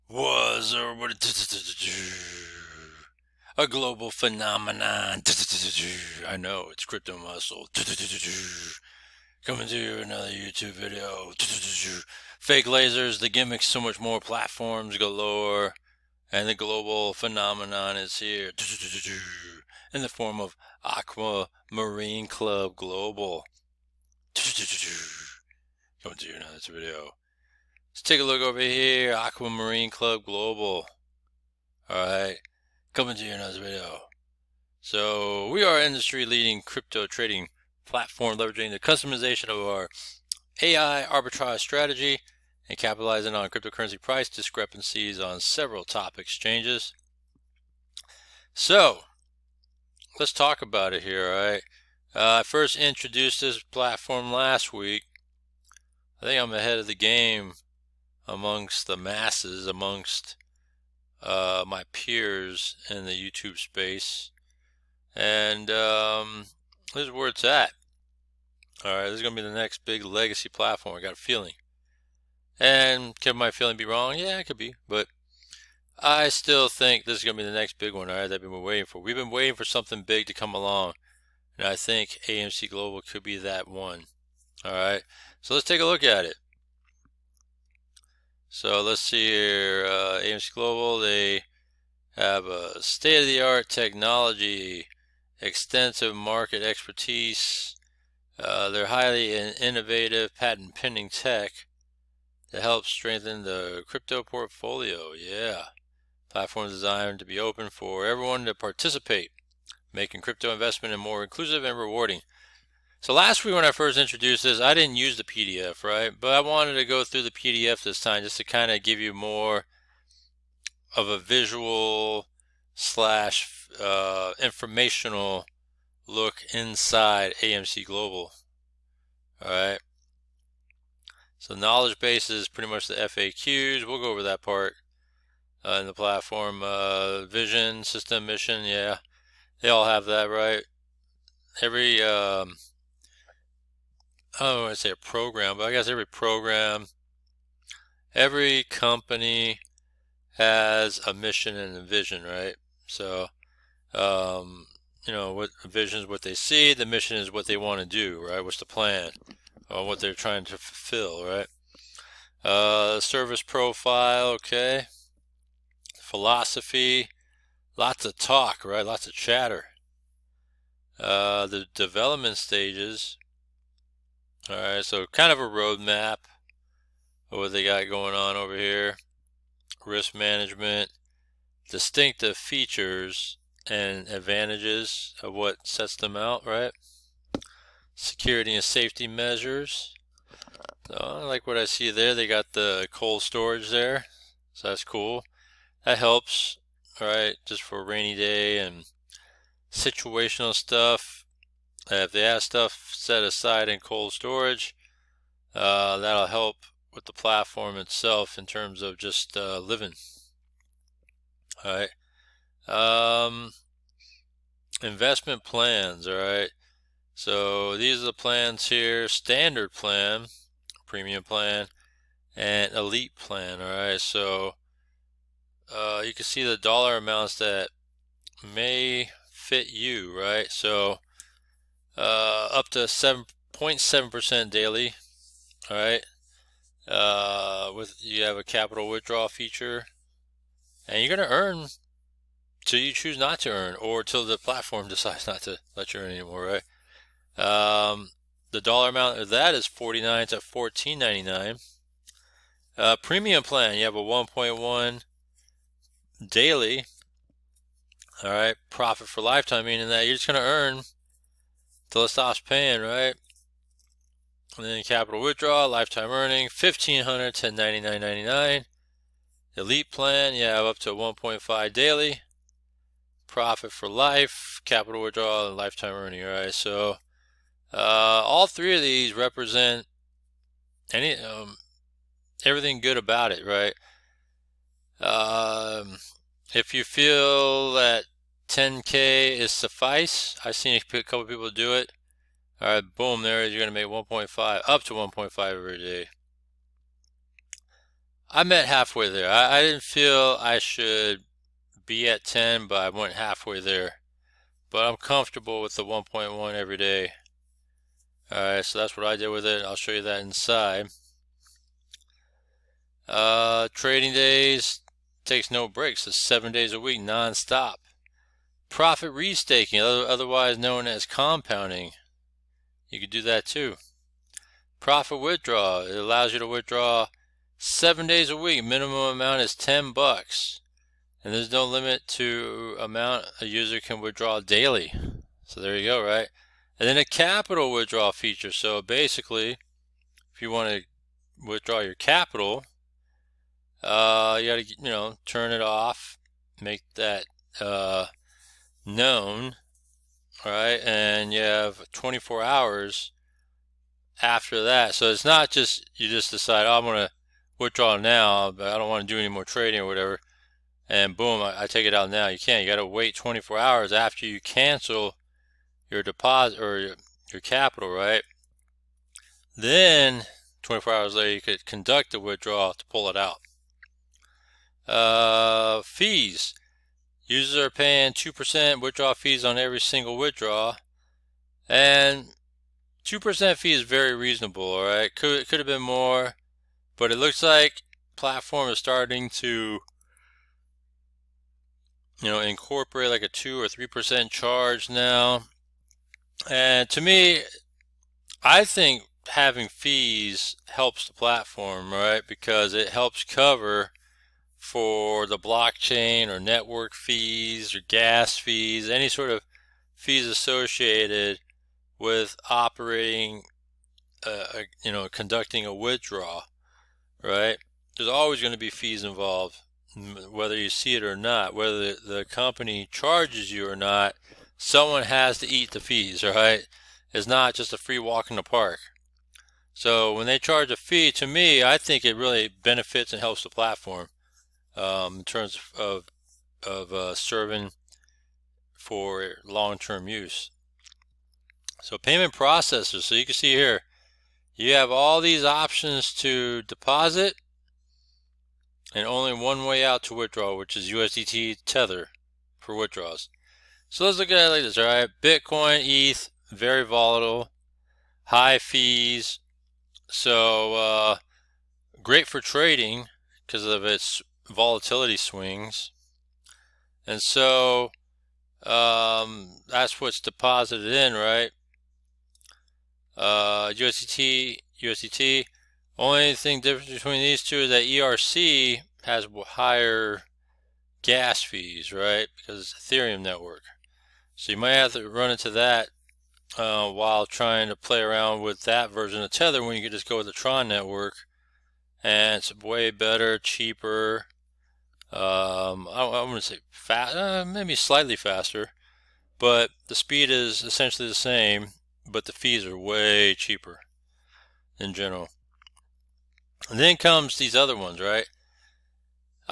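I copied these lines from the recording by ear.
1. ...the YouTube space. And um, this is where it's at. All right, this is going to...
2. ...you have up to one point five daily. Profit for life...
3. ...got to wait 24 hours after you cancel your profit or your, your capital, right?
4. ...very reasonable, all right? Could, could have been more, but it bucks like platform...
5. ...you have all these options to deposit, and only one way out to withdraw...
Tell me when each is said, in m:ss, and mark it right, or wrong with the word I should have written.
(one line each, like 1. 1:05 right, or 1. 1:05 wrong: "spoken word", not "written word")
1. 1:03 right
2. 4:30 right
3. 6:02 wrong: "deposit", not "profit"
4. 6:23 wrong: "looks", not "bucks"
5. 7:24 right.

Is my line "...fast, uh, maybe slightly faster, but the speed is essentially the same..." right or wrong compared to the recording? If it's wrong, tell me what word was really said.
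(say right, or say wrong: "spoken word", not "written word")
right.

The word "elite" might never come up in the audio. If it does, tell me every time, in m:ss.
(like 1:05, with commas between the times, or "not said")
3:42, 4:29.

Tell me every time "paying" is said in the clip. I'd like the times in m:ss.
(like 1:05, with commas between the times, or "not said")
4:22, 6:17.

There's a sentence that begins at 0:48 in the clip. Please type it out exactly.
So, let's talk about it here, all right?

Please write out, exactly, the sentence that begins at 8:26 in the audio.
And then comes these other ones, right?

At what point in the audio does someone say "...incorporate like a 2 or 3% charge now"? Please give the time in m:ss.
6:32.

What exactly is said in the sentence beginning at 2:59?
Risk management, distinctive features and advantages of what sets them out, right?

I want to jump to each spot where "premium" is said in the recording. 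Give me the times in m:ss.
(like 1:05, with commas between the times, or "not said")
3:40, 4:13.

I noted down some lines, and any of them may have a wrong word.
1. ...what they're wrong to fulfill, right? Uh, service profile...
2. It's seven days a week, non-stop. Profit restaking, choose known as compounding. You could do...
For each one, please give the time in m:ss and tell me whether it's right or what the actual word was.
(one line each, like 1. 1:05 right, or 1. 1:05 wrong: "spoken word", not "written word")
1. 2:39 wrong: "trying", not "wrong"
2. 5:16 wrong: "otherwise", not "choose".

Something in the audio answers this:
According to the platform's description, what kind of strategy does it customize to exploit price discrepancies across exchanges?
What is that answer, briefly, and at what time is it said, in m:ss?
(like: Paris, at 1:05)
AI arbitrage strategy, at 0:40.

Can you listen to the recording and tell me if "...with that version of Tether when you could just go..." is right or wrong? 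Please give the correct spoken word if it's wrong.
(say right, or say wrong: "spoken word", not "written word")
right.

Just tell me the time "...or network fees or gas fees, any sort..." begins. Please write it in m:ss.
6:46.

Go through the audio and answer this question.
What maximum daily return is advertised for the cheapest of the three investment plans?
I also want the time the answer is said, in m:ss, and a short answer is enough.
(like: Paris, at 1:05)
7.7%, at 3:52.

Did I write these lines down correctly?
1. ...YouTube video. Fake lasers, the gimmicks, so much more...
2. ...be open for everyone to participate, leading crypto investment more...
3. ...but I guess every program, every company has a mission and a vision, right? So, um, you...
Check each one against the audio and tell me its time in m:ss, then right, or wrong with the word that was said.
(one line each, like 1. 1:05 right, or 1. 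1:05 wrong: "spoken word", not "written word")
1. 0:10 right
2. 1:47 wrong: "making", not "leading"
3. 2:25 right.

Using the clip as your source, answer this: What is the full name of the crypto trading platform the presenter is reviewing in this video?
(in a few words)
Aquamarine Club Global.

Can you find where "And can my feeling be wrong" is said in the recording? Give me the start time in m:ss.
1:12.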